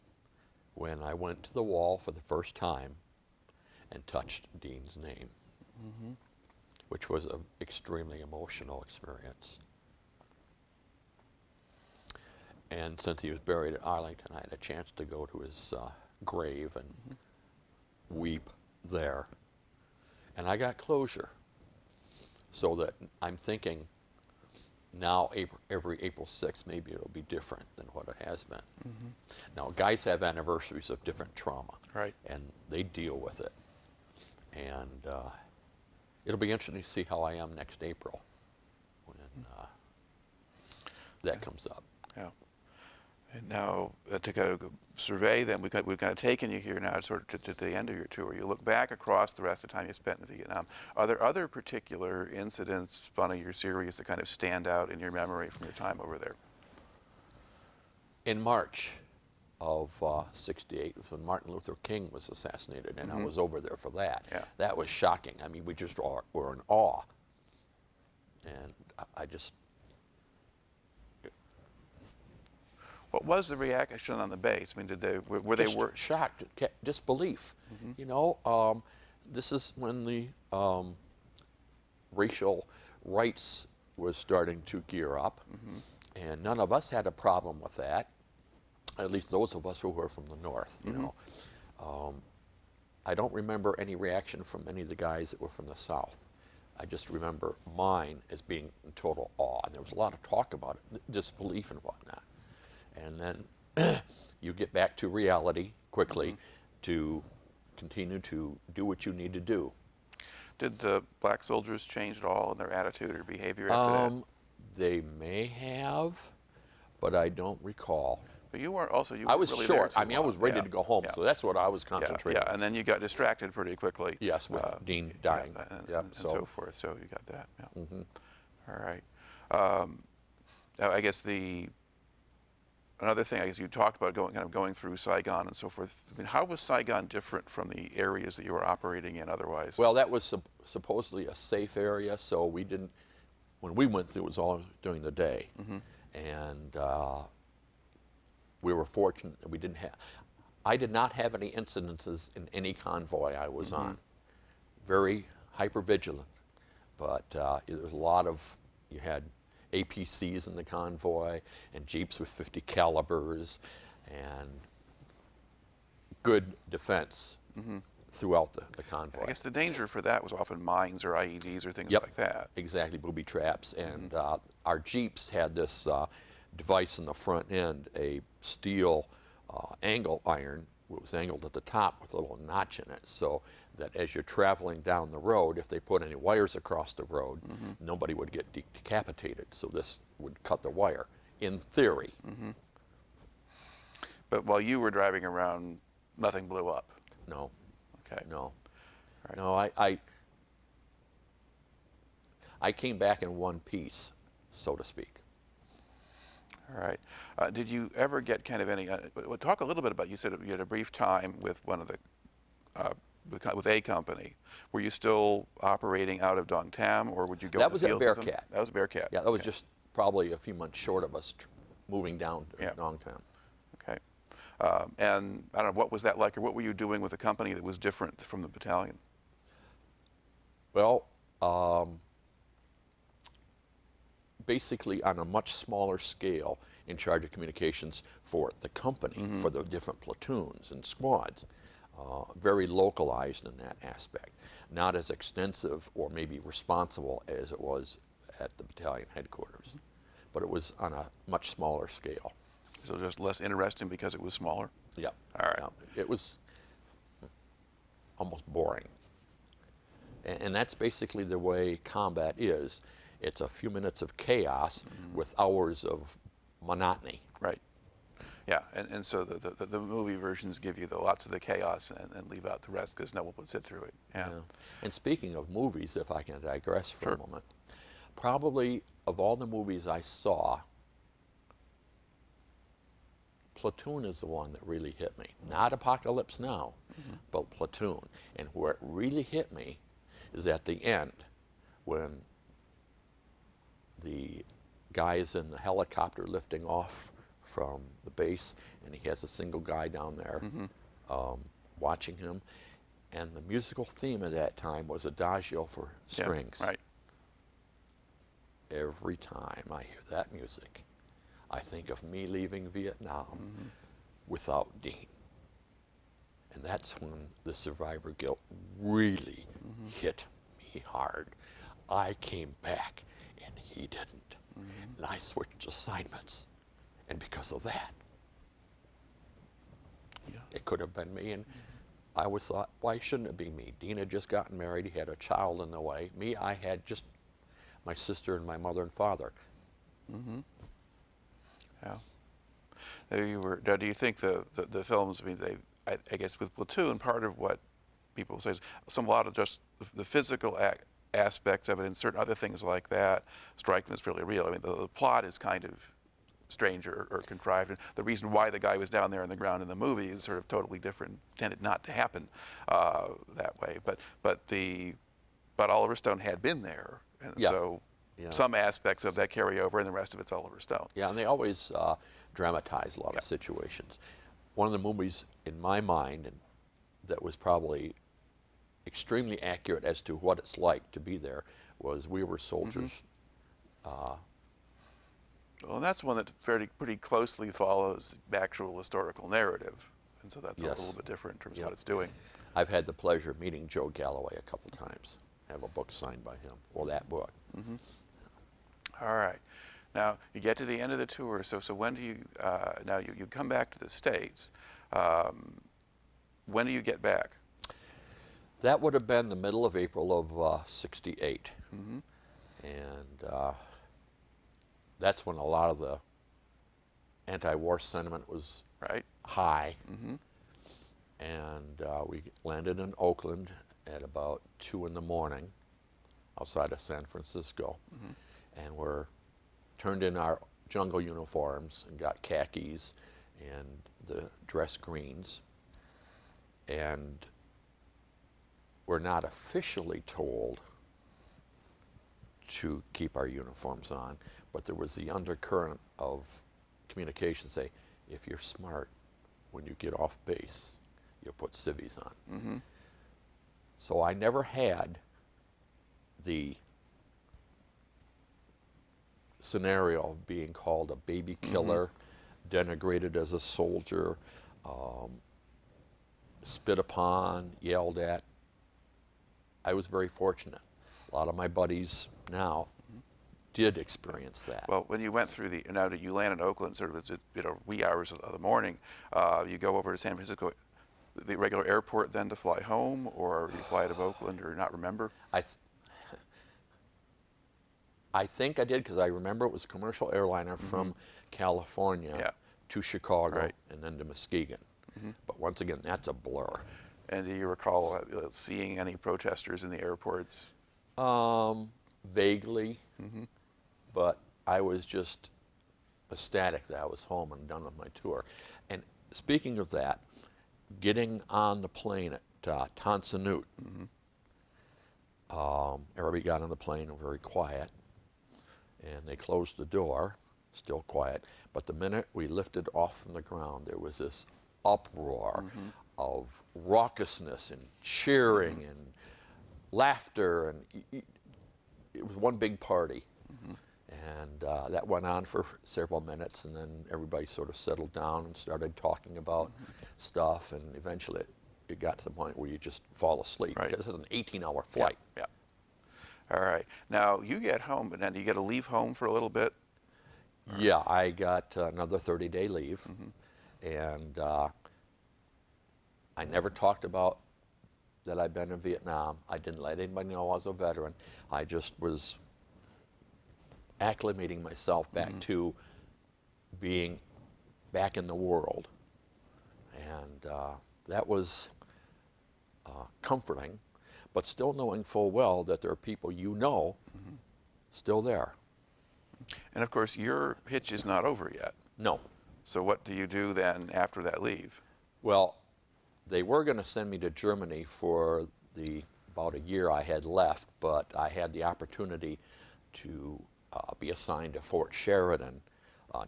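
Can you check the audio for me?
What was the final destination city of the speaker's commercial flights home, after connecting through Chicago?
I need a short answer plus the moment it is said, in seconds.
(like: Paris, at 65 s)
Muskegon, at 494 s.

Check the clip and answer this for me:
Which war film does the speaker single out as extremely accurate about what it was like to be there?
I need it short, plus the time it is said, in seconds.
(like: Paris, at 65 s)
We Were Soldiers, at 382 s.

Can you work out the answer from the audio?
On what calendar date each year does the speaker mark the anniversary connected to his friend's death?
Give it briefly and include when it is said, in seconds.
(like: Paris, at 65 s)
April 6, at 26 s.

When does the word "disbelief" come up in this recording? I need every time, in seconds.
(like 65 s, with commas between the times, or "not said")
76 s, 101 s.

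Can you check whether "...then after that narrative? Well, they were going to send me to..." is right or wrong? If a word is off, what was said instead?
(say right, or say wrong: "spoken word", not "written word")
wrong: "leave", not "narrative".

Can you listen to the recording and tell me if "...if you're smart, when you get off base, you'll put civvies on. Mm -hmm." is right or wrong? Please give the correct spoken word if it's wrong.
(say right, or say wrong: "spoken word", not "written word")
right.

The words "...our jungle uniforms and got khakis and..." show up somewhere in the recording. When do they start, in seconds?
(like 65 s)
430 s.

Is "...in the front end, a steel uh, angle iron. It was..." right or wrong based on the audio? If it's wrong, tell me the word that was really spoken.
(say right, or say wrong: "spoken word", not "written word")
right.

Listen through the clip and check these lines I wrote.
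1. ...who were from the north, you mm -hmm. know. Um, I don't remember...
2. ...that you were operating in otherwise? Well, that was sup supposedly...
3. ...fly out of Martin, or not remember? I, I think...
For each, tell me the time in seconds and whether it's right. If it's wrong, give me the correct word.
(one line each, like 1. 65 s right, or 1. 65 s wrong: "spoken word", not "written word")
1. 89 s right
2. 138 s right
3. 483 s wrong: "Oakland", not "Martin".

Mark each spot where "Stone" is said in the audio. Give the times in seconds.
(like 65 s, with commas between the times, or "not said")
365 s, 370 s.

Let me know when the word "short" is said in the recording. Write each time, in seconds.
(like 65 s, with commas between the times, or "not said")
119 s, 220 s.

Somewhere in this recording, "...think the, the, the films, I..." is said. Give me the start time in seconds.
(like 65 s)
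343 s.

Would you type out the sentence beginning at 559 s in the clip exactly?
I didn't let anybody know I was a veteran.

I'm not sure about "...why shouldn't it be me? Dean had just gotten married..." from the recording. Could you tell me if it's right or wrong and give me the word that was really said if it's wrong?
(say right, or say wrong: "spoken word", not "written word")
right.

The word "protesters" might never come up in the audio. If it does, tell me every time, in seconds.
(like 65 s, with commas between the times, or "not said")
498 s.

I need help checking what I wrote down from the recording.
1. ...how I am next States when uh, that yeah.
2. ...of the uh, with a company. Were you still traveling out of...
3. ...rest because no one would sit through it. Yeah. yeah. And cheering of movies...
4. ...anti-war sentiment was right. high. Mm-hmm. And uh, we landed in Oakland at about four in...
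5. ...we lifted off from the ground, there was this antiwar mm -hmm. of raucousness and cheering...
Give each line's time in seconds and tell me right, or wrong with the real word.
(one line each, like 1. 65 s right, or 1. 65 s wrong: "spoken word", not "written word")
1. 37 s wrong: "April", not "States"
2. 211 s wrong: "operating", not "traveling"
3. 272 s wrong: "speaking", not "cheering"
4. 417 s wrong: "two", not "four"
5. 522 s wrong: "uproar", not "antiwar".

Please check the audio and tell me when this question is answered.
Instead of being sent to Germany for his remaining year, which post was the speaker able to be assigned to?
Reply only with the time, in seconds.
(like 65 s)
594 s.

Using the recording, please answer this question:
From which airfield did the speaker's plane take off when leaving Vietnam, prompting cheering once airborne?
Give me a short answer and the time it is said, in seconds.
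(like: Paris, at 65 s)
Tan Son Nhut, at 512 s.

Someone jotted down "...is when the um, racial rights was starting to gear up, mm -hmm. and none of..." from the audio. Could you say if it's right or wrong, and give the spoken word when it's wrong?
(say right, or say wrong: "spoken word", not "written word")
right.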